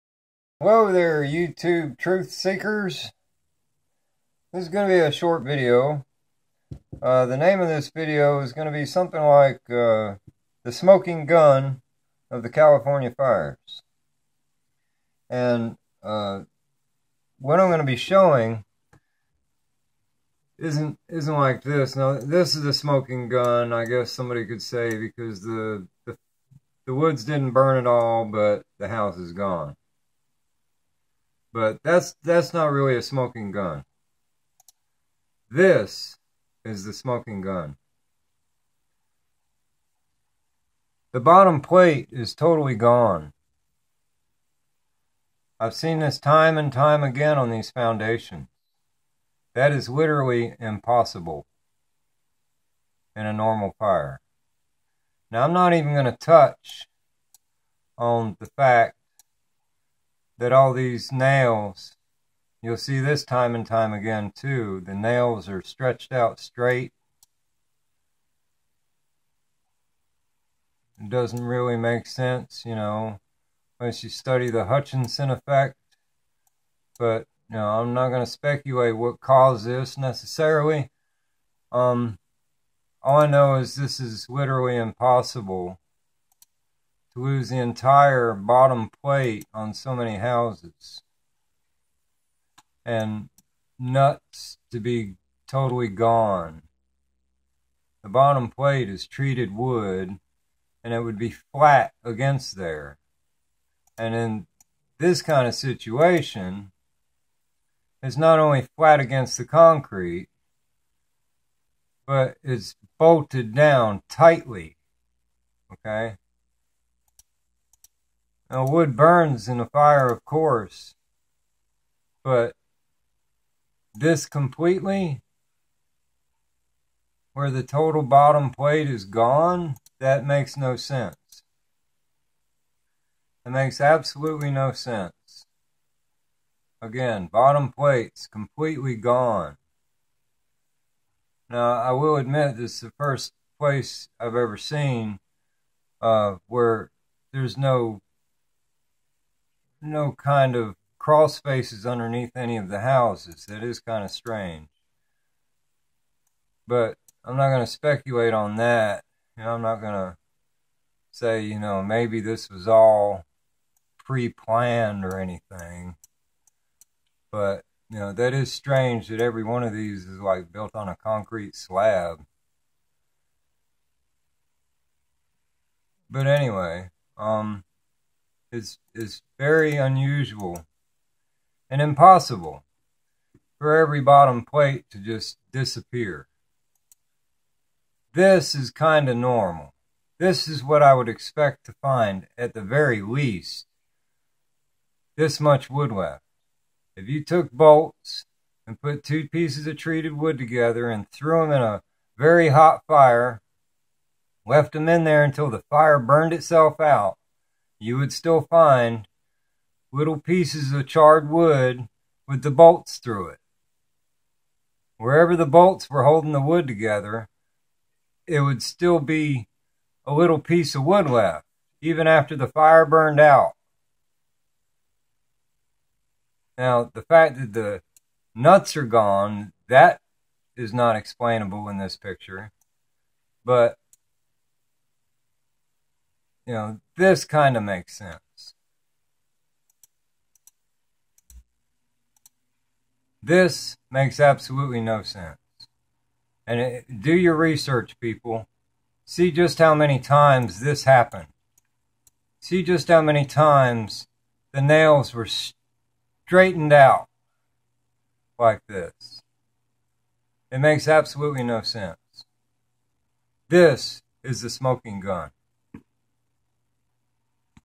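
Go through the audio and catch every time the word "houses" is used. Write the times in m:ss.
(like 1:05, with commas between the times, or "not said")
0:28, 1:30, 2:32.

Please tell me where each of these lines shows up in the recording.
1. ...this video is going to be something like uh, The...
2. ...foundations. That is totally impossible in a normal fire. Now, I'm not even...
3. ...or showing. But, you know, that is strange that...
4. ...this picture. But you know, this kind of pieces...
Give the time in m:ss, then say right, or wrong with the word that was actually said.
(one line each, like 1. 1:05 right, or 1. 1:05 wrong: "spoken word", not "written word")
1. 0:07 right
2. 0:47 wrong: "literally", not "totally"
3. 2:45 wrong: "anything", not "showing"
4. 3:51 wrong: "makes", not "pieces".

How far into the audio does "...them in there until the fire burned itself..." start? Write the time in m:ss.
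3:24.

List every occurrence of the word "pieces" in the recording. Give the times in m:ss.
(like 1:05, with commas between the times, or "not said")
3:19, 3:30, 3:40.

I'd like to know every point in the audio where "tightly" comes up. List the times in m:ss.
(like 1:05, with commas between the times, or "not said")
1:54.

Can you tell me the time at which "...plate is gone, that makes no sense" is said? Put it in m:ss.
2:08.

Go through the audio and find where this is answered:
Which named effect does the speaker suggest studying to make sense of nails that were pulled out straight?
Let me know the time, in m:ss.
1:14.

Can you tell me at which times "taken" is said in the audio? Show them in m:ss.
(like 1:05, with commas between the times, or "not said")
not said.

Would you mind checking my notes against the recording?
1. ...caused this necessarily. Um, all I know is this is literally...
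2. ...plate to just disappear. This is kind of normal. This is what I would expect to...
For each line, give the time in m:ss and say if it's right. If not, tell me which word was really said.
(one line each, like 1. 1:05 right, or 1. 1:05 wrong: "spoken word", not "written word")
1. 1:19 right
2. 3:04 right.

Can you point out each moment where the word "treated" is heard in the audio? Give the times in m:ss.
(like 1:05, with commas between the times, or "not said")
1:39, 3:19.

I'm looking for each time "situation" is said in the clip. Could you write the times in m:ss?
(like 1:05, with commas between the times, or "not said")
1:45.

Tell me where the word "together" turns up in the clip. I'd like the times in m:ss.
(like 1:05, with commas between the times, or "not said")
3:20, 3:36.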